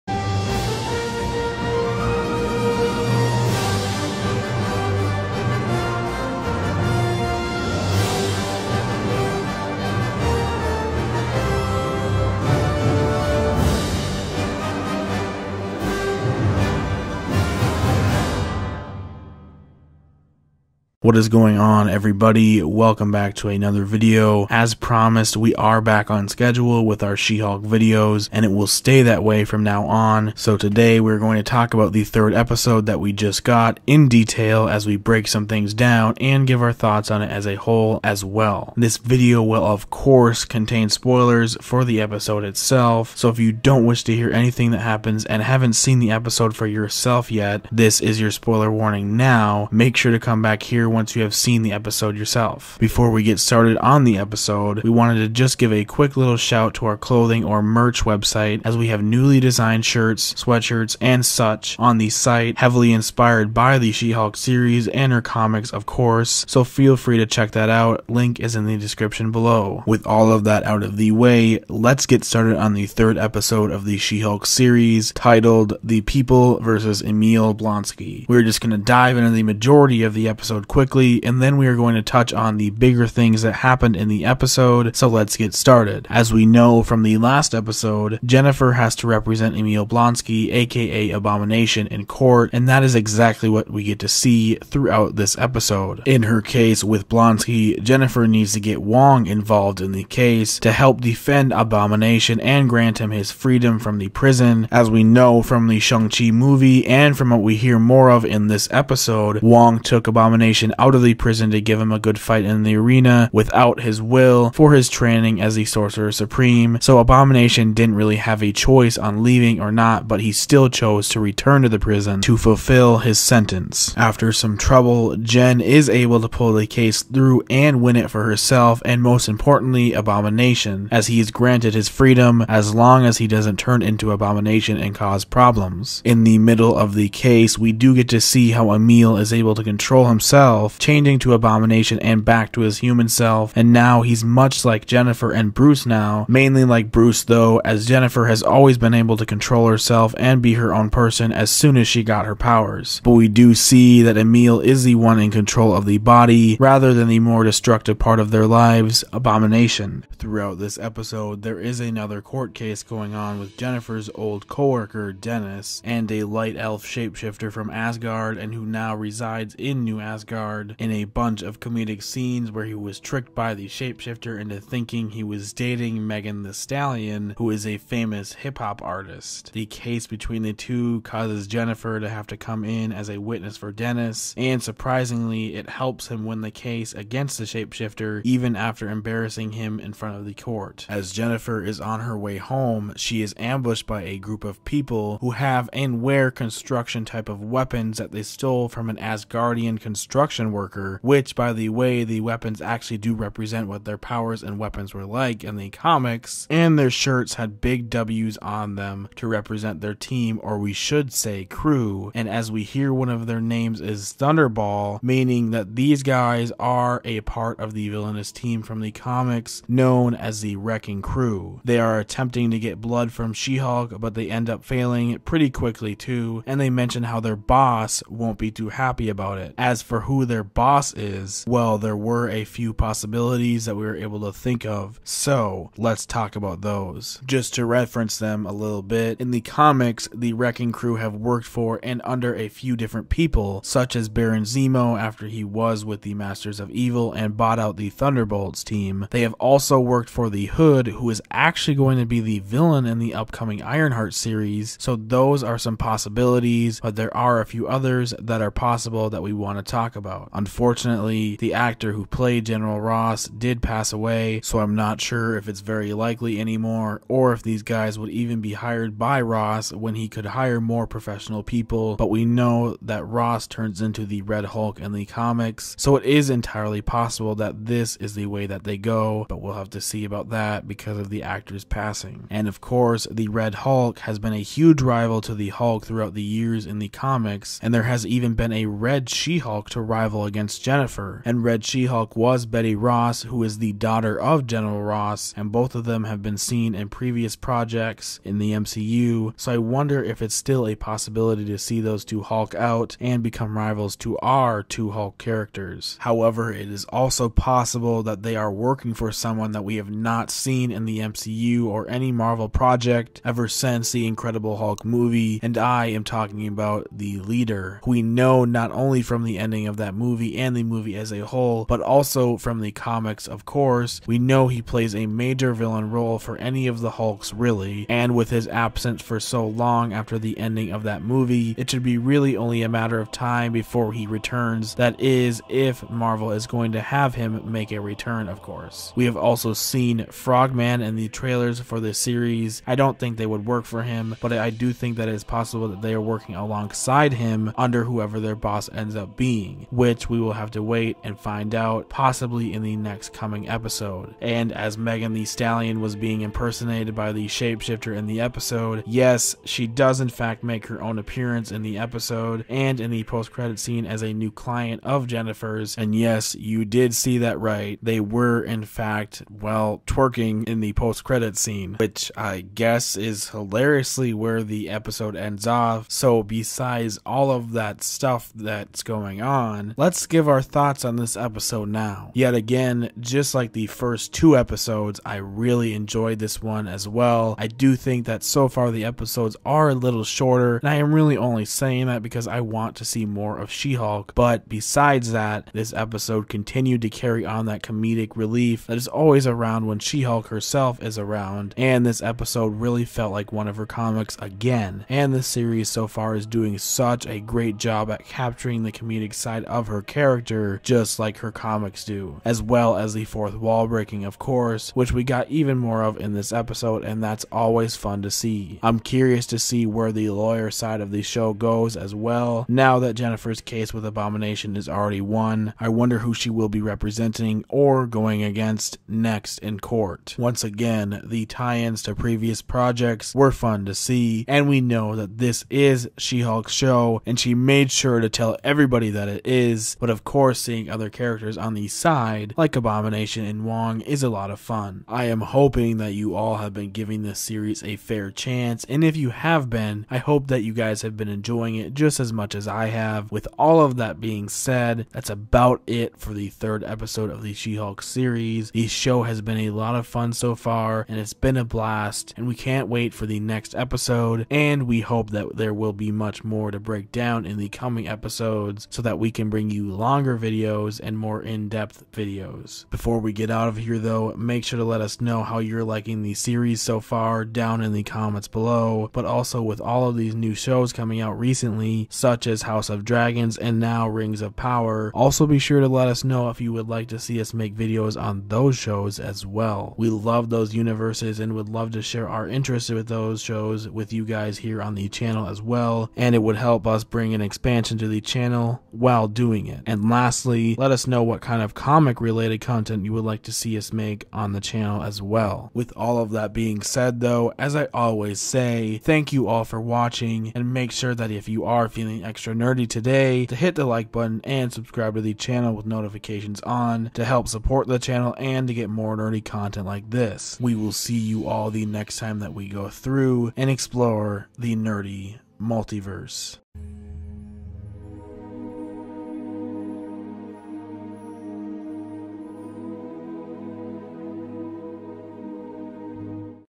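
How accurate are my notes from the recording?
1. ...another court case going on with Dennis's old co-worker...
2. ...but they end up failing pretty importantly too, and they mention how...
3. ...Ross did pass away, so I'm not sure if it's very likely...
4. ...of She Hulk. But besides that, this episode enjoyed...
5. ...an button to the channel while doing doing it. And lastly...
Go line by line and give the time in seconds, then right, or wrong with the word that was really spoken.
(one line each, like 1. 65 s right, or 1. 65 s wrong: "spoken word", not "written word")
1. 161 s wrong: "Jennifer", not "Dennis"
2. 223 s wrong: "quickly", not "importantly"
3. 262 s right
4. 393 s wrong: "continued", not "enjoyed"
5. 497 s wrong: "expansion", not "button".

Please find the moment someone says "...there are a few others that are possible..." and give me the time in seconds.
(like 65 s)
256 s.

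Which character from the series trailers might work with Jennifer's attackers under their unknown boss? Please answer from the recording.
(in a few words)
Frogman.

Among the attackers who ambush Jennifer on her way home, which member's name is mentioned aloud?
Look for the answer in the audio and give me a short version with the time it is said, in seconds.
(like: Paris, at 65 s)
Thunderball, at 214 s.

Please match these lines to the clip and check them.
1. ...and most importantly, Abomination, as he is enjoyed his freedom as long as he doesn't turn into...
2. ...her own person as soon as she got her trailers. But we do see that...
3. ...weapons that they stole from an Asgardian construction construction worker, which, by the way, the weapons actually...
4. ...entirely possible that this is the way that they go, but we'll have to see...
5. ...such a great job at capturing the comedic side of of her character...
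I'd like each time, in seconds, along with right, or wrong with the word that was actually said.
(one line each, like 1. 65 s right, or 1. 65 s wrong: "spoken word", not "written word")
1. 128 s wrong: "granted", not "enjoyed"
2. 150 s wrong: "powers", not "trailers"
3. 197 s right
4. 276 s right
5. 406 s right.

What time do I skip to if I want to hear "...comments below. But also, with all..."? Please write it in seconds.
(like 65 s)
477 s.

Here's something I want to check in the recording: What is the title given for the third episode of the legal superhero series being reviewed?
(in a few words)
The People versus Emil Blonsky.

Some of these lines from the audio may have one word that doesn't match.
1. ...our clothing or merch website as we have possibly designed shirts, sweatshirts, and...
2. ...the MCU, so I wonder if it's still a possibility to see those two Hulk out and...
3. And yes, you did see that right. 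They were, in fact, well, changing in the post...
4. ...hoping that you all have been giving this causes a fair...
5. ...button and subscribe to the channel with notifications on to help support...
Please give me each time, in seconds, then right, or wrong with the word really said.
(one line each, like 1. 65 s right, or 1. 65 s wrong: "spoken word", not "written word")
1. 56 s wrong: "newly", not "possibly"
2. 298 s right
3. 365 s wrong: "twerking", not "changing"
4. 445 s wrong: "series", not "causes"
5. 513 s right.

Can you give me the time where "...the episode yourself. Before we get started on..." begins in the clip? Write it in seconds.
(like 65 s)
51 s.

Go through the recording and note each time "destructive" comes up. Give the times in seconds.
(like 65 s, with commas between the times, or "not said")
157 s.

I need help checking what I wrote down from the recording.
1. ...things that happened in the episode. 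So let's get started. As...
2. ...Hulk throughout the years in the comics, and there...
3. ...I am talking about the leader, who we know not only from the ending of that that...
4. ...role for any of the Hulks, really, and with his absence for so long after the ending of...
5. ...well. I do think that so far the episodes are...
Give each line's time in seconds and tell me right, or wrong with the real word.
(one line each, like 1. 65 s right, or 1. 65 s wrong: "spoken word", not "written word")
1. 83 s right
2. 285 s right
3. 315 s right
4. 325 s right
5. 386 s right.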